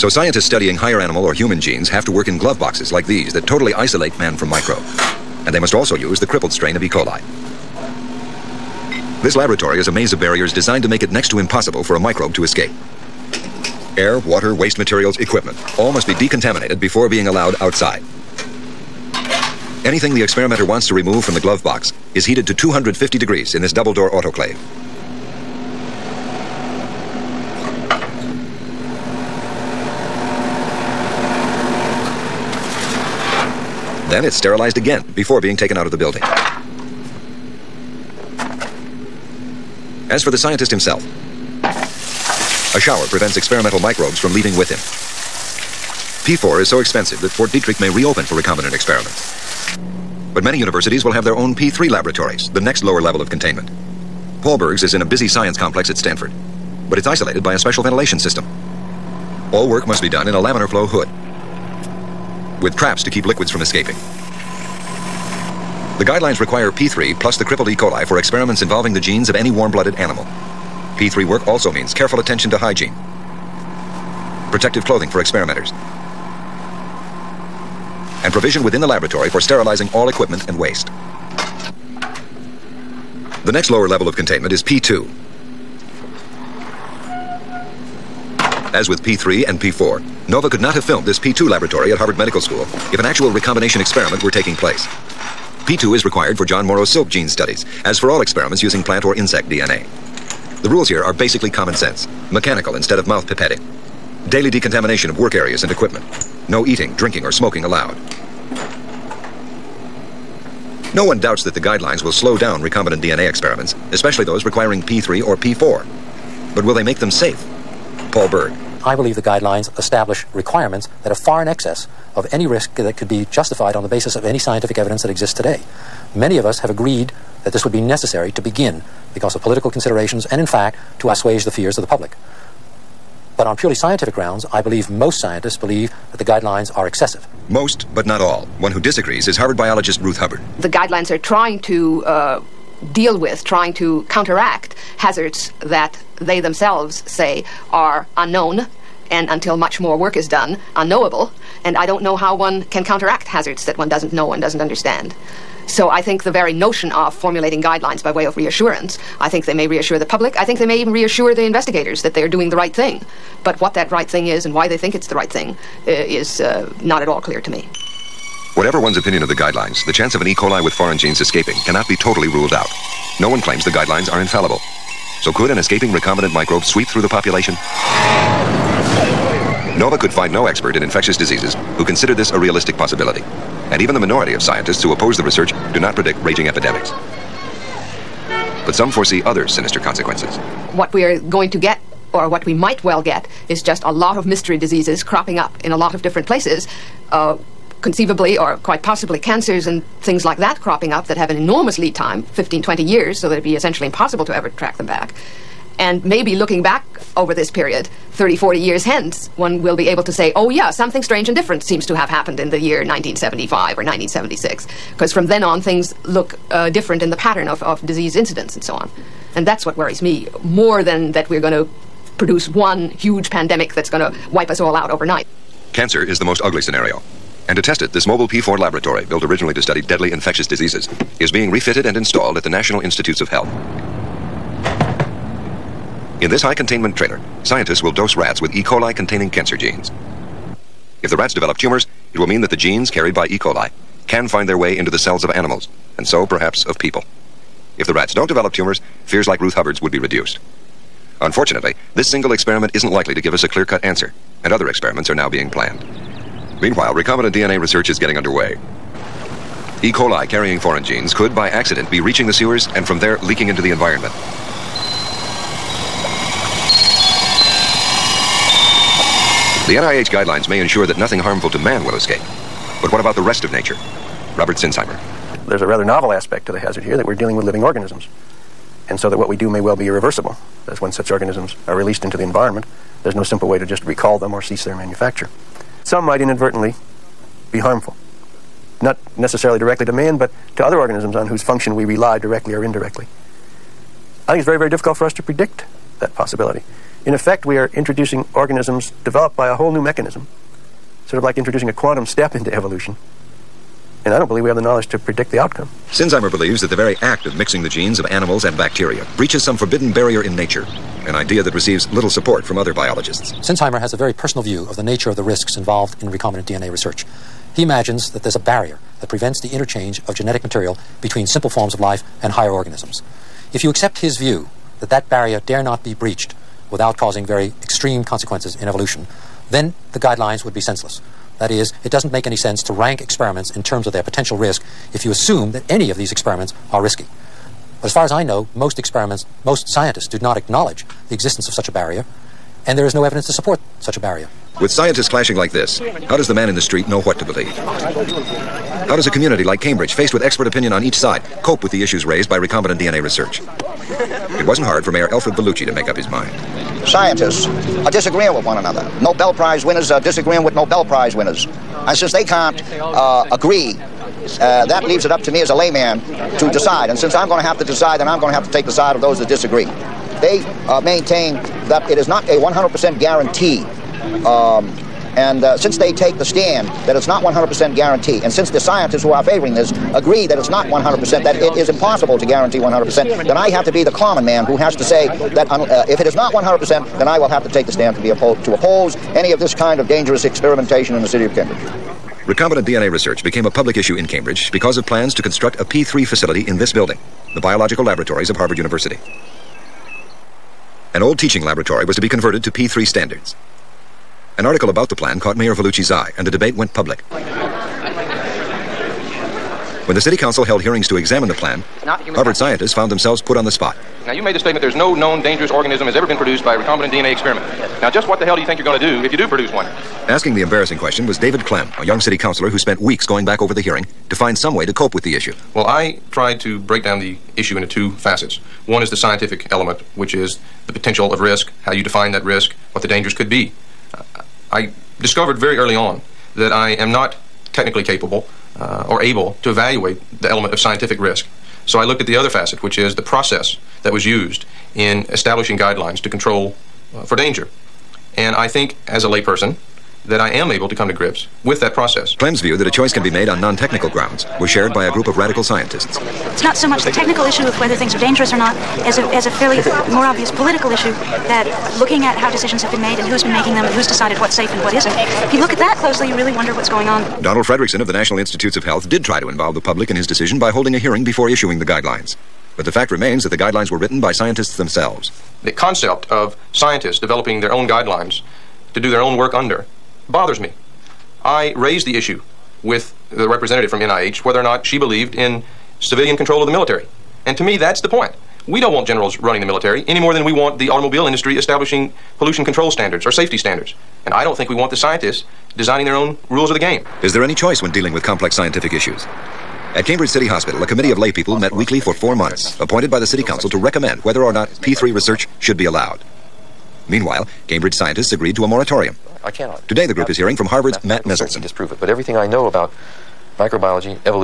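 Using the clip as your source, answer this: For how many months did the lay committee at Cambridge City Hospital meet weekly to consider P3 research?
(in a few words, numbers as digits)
4 months.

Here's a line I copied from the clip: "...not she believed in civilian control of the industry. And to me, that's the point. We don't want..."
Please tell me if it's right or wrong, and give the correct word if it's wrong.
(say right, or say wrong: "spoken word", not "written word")
wrong: "military", not "industry".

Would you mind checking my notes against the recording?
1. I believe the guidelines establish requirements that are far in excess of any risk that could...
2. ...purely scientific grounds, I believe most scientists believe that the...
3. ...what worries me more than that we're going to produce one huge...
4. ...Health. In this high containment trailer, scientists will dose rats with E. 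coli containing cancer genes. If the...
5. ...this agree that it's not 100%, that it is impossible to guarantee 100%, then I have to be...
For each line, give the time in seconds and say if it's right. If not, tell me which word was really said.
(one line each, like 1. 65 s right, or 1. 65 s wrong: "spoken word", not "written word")
1. 118 s right
2. 133 s right
3. 219 s right
4. 233 s right
5. 379 s right.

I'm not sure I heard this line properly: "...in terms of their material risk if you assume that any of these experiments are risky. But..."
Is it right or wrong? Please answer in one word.
wrong.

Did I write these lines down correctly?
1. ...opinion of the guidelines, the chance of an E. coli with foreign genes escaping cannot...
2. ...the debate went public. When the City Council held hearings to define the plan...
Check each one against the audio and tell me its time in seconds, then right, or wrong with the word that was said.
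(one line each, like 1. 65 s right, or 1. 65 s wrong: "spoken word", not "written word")
1. 168 s right
2. 406 s wrong: "examine", not "define".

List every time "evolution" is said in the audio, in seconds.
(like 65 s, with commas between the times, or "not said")
302 s, 328 s.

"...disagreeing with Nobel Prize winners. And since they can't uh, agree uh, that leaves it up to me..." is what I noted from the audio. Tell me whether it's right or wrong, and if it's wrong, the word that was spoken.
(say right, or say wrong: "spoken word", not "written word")
right.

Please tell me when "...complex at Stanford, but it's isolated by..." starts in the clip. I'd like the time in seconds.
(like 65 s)
55 s.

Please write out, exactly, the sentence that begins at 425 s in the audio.
Well, I tried to break down the issue into two facets.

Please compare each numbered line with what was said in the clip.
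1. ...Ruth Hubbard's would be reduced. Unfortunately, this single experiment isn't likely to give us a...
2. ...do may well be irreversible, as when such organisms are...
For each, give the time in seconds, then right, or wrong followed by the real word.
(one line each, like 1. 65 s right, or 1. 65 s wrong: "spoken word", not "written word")
1. 249 s right
2. 279 s right.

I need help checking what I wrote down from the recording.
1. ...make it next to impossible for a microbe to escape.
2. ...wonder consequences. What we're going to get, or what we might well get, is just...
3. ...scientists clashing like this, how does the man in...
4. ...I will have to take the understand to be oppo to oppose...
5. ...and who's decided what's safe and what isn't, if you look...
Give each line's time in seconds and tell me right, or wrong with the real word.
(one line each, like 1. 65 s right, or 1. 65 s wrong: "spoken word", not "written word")
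1. 10 s right
2. 189 s wrong: "sinister", not "wonder"
3. 344 s right
4. 387 s wrong: "stand", not "understand"
5. 463 s right.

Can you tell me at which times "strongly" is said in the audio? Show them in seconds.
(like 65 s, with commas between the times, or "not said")
not said.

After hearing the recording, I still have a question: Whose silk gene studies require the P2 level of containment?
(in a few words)
John Morrow.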